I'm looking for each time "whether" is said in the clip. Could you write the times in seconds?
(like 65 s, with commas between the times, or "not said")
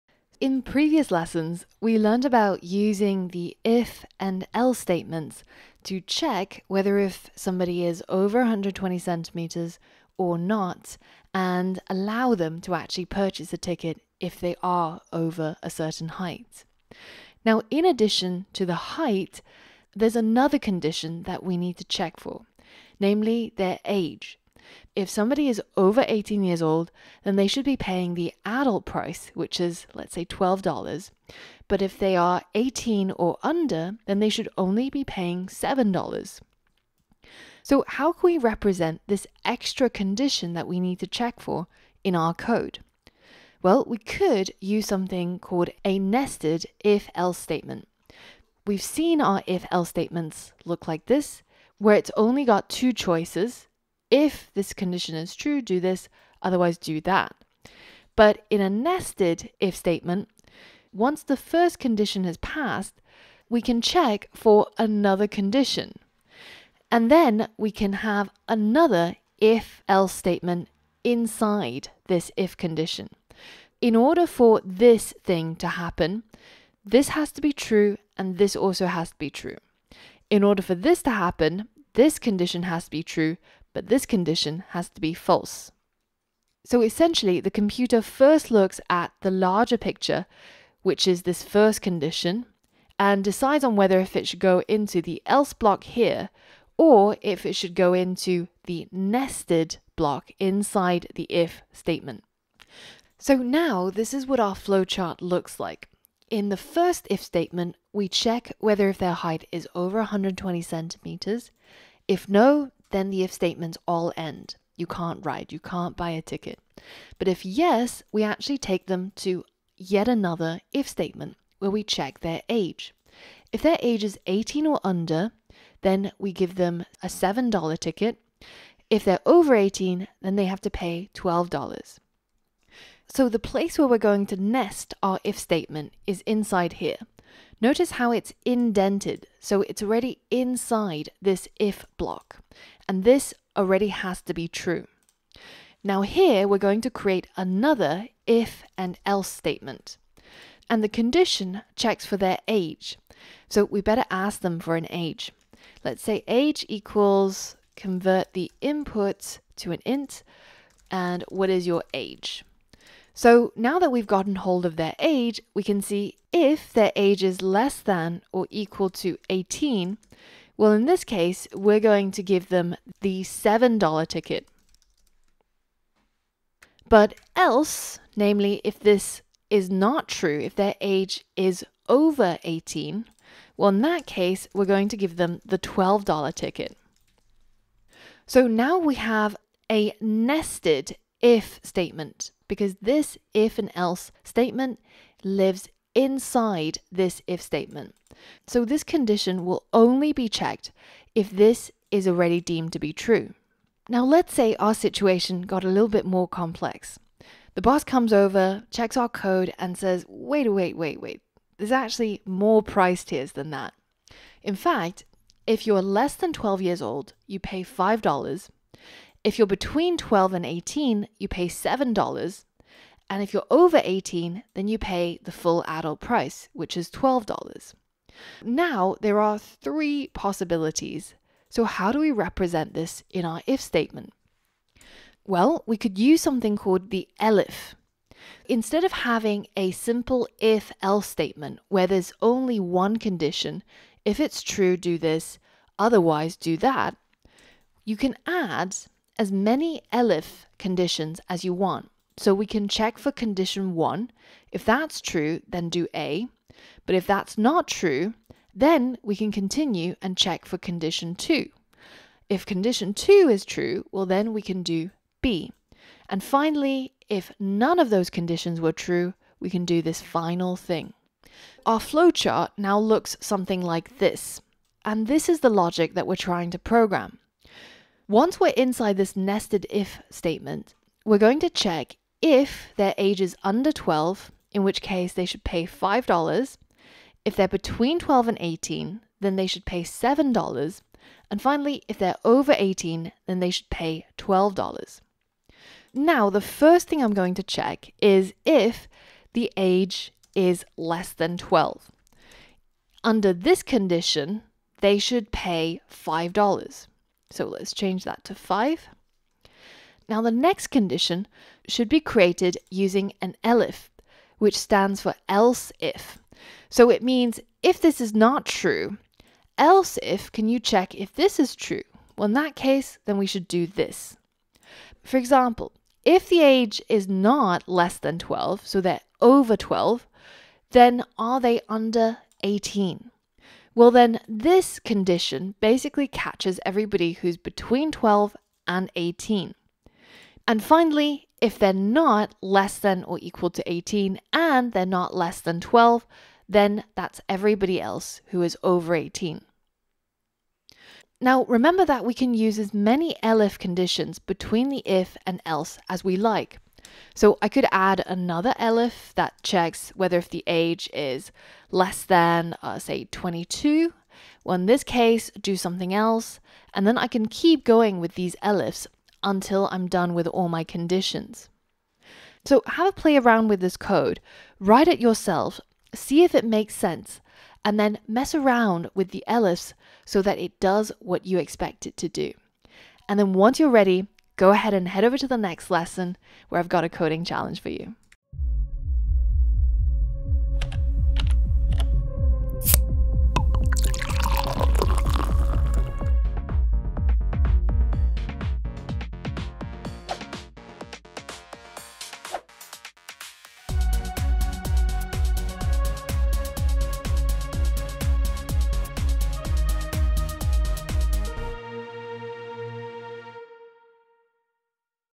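6 s, 93 s, 108 s, 359 s.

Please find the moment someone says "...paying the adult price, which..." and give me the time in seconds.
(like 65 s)
27 s.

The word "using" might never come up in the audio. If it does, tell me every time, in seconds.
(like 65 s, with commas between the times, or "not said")
2 s, 312 s.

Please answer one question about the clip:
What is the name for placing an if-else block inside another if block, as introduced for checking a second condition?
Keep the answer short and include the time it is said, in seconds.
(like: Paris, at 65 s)
nested if else statement, at 45 s.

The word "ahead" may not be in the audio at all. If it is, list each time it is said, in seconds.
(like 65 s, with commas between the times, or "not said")
384 s.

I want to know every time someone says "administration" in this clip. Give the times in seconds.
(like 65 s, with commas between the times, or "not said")
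not said.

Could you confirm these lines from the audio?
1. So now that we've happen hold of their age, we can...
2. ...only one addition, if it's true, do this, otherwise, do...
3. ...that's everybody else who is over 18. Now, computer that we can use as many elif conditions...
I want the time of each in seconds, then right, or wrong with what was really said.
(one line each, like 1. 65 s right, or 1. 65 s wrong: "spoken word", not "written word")
1. 163 s wrong: "gotten", not "happen"
2. 242 s wrong: "condition", not "addition"
3. 346 s wrong: "remember", not "computer".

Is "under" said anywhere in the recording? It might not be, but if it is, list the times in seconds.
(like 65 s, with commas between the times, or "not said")
33 s, 124 s, 283 s, 303 s, 331 s.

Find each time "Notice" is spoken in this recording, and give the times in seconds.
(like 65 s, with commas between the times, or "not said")
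137 s.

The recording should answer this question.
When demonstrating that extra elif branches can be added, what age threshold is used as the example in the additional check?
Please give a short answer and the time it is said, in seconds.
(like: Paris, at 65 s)
22, at 363 s.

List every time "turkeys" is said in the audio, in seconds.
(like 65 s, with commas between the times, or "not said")
not said.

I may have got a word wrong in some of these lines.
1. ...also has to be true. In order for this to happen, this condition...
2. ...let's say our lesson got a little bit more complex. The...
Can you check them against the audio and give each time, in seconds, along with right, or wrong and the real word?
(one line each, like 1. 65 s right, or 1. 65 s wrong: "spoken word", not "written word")
1. 78 s right
2. 204 s wrong: "situation", not "lesson".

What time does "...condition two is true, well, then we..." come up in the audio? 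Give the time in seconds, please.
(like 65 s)
262 s.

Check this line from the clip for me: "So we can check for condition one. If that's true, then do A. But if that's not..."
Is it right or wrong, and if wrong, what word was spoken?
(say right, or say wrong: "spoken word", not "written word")
right.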